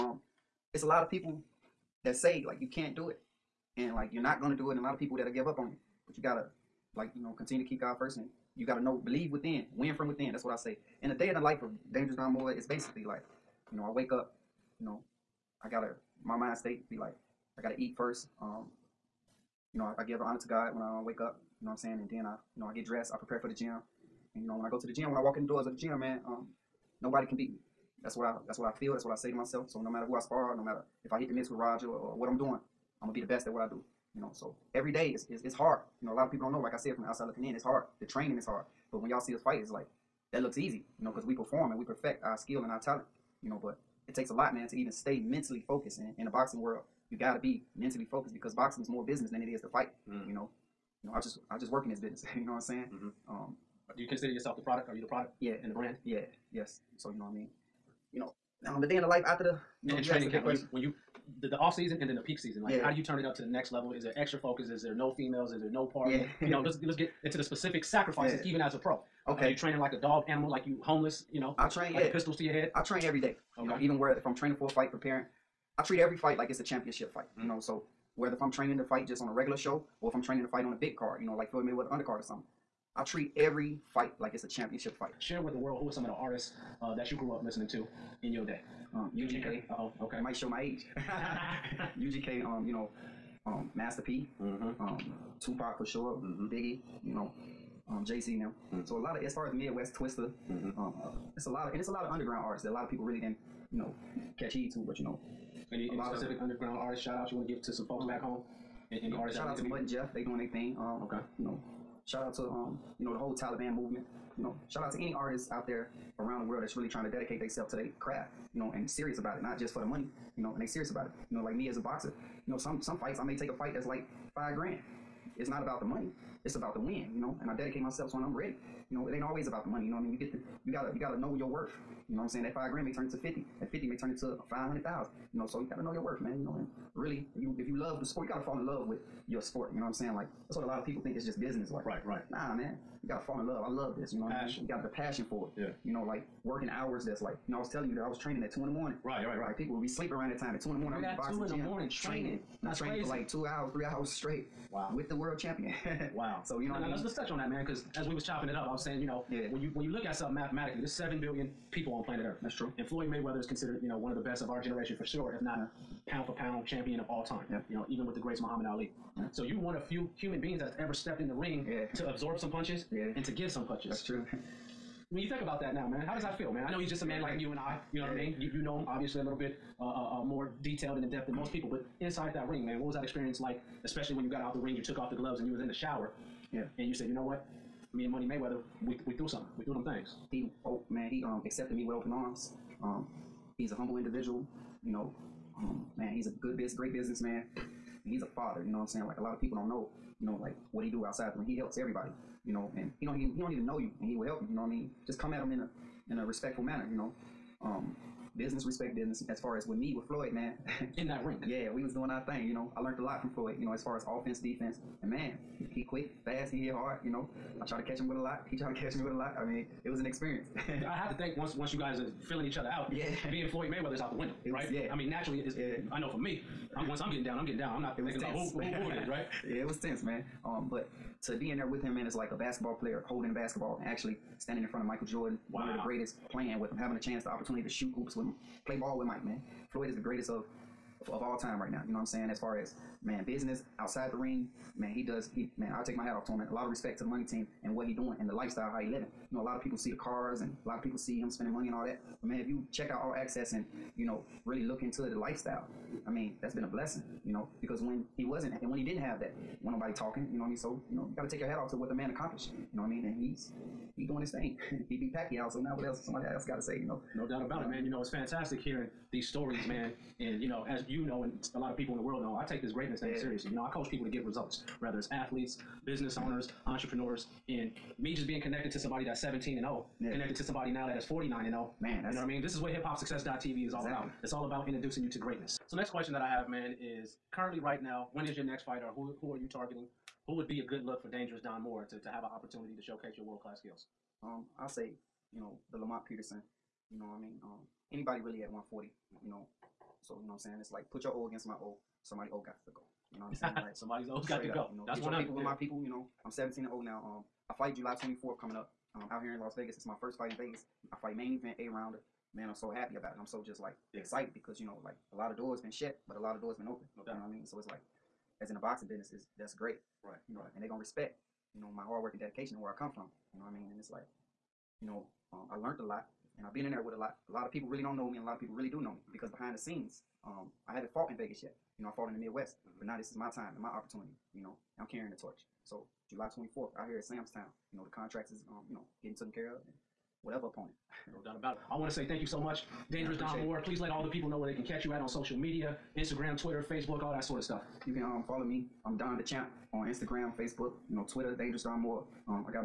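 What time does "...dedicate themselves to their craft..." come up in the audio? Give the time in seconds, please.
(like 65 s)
117 s.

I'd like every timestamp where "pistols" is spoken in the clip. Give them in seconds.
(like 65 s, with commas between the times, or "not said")
72 s.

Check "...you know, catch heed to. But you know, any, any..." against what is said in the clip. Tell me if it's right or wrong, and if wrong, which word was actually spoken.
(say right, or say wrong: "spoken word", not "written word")
right.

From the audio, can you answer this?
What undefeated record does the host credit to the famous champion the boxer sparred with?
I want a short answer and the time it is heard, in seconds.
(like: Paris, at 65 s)
49 and 0, at 281 s.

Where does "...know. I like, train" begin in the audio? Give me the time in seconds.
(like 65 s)
71 s.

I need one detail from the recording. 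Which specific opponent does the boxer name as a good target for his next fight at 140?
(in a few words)
Lamont Peterson.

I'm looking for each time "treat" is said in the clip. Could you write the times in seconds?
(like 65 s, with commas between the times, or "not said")
75 s, 83 s.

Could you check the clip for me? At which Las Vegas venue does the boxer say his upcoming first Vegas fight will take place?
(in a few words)
Sam's Town.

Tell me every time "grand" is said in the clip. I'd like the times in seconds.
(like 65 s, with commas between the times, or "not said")
124 s, 132 s.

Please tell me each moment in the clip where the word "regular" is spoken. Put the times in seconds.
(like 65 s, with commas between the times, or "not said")
79 s.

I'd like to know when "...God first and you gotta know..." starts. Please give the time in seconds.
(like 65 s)
7 s.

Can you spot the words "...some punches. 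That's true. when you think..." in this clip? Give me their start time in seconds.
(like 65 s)
173 s.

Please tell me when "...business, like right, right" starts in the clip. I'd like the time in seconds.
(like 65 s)
141 s.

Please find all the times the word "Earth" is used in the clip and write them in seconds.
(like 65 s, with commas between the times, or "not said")
162 s.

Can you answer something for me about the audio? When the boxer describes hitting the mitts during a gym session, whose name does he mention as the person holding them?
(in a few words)
Roger.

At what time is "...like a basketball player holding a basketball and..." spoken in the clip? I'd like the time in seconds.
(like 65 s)
232 s.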